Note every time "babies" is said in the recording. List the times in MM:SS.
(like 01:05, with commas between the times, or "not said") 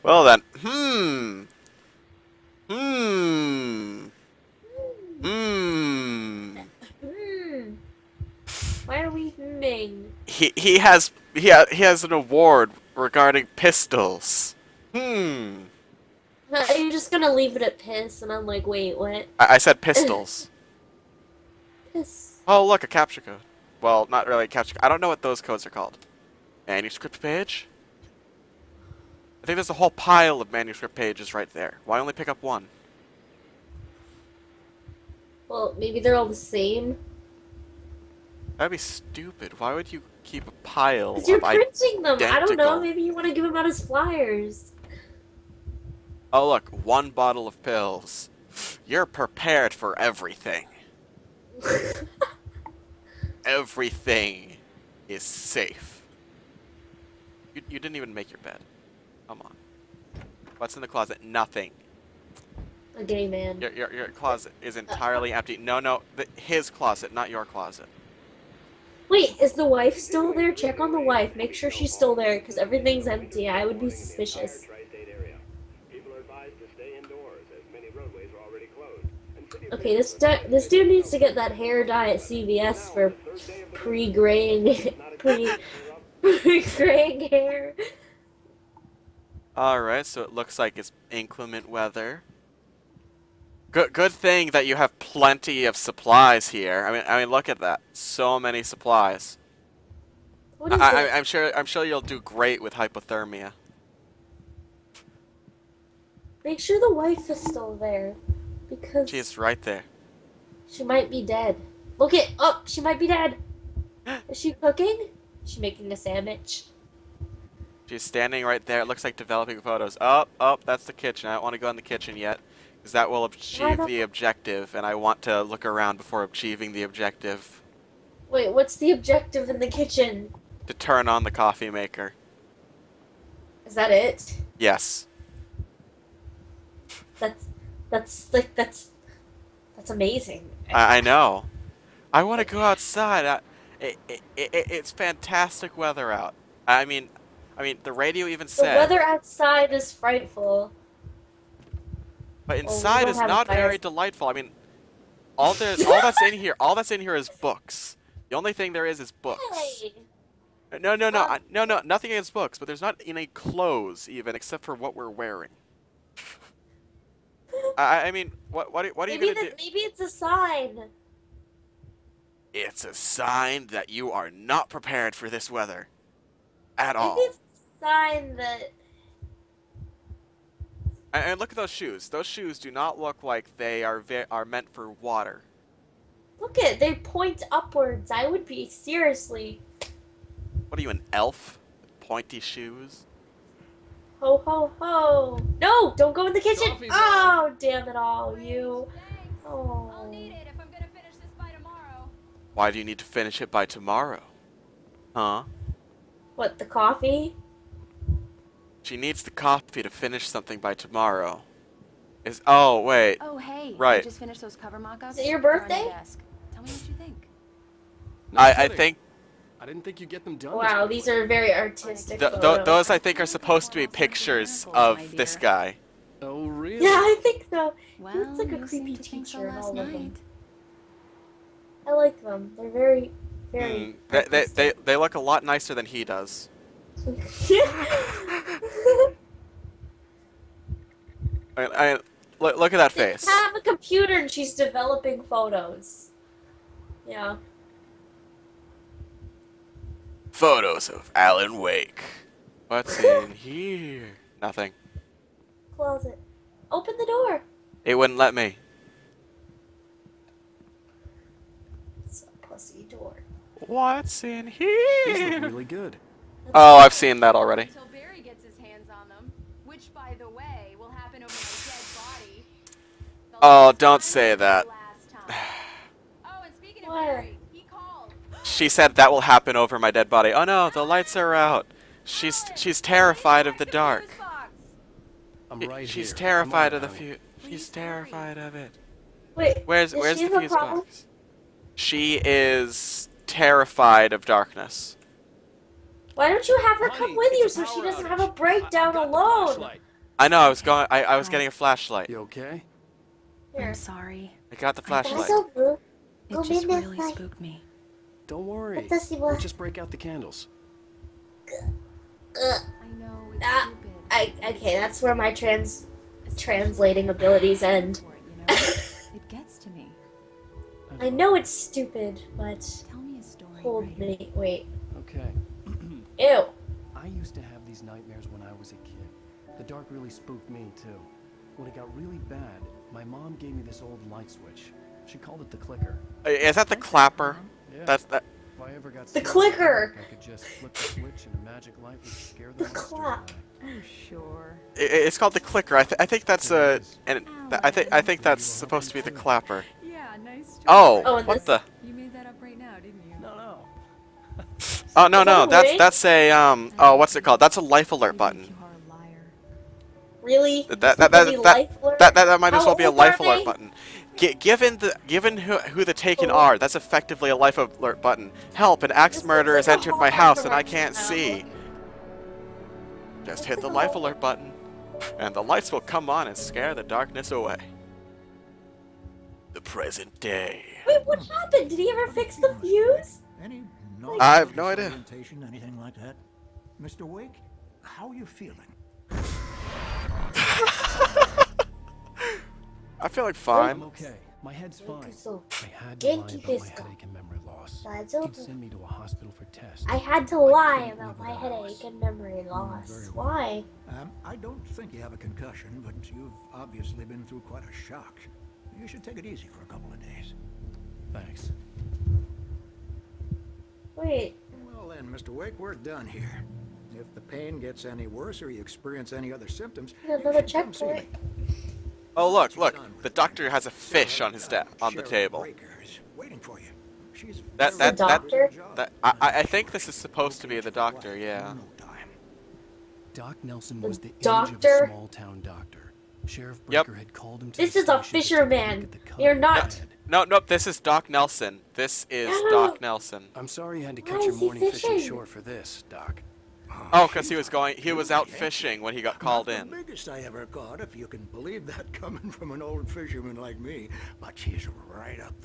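not said.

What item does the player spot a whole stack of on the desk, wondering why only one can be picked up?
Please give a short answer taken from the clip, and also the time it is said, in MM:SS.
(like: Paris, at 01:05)
Manuscript pages, at 00:30.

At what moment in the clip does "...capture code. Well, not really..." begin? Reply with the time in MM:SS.
00:22.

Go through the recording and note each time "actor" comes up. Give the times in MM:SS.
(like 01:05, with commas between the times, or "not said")
not said.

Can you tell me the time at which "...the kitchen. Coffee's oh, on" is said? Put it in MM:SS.
03:16.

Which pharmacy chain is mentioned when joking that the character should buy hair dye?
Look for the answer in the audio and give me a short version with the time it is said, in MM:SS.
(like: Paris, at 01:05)
CVS, at 01:22.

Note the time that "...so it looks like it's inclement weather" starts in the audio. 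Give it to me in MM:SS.
01:30.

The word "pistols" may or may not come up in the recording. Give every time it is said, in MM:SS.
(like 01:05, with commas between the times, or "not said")
00:13, 00:19.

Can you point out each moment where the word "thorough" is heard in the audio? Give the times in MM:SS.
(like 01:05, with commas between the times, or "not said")
not said.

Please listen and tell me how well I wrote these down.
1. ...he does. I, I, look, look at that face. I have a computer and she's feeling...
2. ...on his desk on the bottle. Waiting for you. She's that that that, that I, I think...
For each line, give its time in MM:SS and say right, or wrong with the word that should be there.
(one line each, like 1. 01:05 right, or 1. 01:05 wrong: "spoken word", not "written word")
1. 03:55 wrong: "developing", not "feeling"
2. 07:04 wrong: "table", not "bottle".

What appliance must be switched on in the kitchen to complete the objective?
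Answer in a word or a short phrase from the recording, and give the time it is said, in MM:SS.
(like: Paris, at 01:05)
Coffee maker, at 02:11.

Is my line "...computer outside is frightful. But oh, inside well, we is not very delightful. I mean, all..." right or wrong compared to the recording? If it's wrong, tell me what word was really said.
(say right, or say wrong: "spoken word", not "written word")
wrong: "weather", not "computer".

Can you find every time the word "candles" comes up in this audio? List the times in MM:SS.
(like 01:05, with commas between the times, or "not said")
05:09.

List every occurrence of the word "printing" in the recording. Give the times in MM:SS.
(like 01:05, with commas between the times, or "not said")
00:41.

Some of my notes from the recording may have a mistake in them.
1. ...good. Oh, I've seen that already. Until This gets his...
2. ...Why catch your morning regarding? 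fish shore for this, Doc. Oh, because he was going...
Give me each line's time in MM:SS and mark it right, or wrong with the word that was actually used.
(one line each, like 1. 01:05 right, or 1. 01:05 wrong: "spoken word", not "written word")
1. 04:25 wrong: "Barry", not "This"
2. 07:24 wrong: "fishing", not "regarding".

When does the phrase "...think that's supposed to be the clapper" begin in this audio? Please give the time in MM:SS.
05:48.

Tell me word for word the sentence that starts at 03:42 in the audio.
Th th those I think are supposed to be pictures of this guy.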